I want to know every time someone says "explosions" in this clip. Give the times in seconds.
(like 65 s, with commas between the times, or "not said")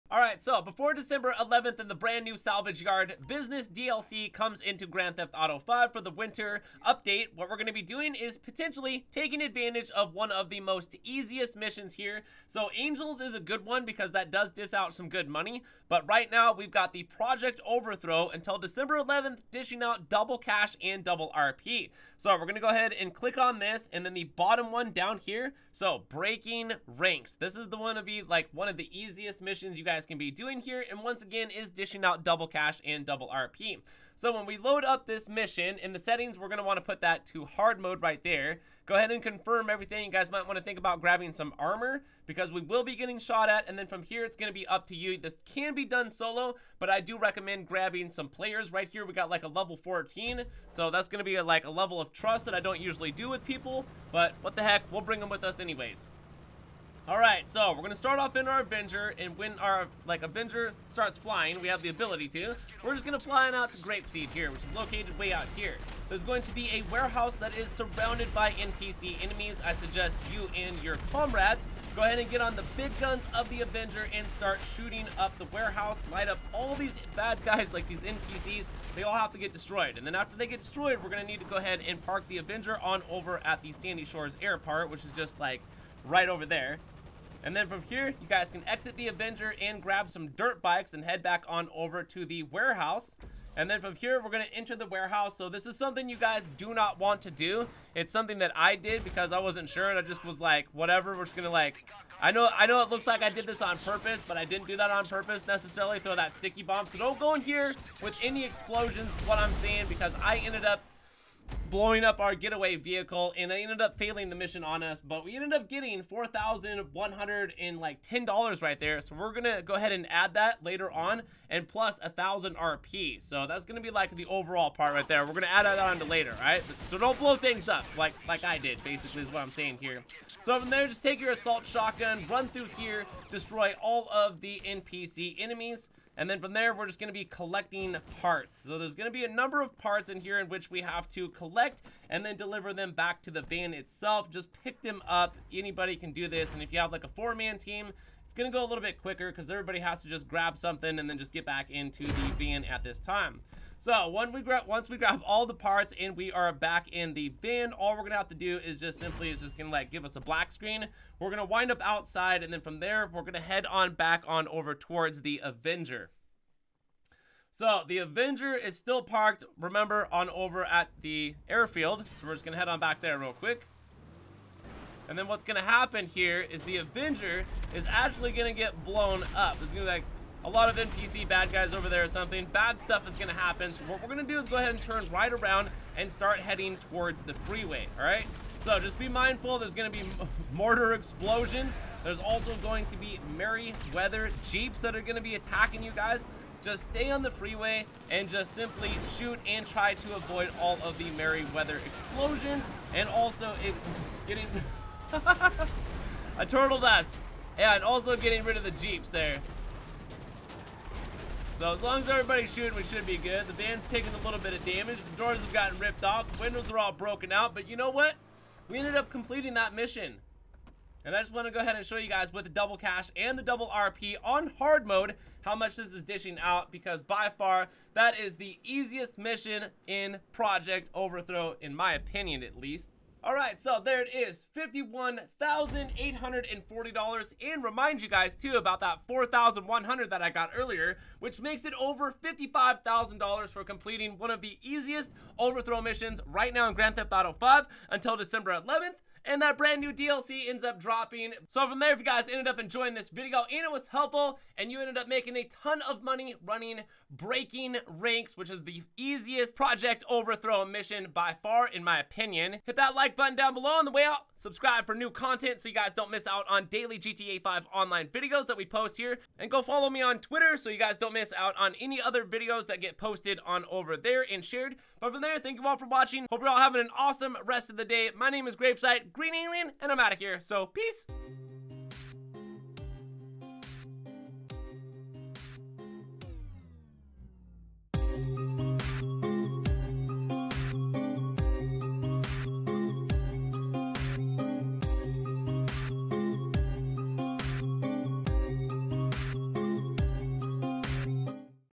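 108 s, 190 s, 201 s.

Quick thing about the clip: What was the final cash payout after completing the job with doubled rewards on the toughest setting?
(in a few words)
$51,840.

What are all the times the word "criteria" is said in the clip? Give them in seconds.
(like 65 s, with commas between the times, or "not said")
not said.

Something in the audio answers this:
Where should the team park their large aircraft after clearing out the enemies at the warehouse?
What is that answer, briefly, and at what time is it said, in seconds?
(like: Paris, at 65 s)
Sandy Shores Airport, at 83 s.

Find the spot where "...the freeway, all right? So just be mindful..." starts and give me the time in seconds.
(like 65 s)
187 s.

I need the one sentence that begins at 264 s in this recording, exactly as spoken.
Subscribe for new content so you guys don't miss out on daily GTA 5 online videos that we post here.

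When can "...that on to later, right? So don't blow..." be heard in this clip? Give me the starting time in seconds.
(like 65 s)
125 s.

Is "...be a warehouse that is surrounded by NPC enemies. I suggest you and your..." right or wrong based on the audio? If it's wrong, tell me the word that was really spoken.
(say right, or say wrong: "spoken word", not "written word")
right.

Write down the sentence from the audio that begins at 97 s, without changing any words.
It's something that I did because I wasn't sure.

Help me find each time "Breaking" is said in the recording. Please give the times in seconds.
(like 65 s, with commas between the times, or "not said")
26 s, 257 s.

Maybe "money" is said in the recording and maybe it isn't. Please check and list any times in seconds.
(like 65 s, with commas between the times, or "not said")
15 s, 256 s.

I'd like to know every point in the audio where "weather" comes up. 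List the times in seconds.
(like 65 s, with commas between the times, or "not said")
193 s, 201 s.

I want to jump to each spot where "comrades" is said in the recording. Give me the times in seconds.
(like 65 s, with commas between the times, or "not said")
71 s.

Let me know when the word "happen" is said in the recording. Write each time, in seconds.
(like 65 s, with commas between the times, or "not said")
175 s, 183 s.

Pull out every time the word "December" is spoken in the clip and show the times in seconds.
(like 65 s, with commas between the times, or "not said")
0 s, 18 s, 248 s.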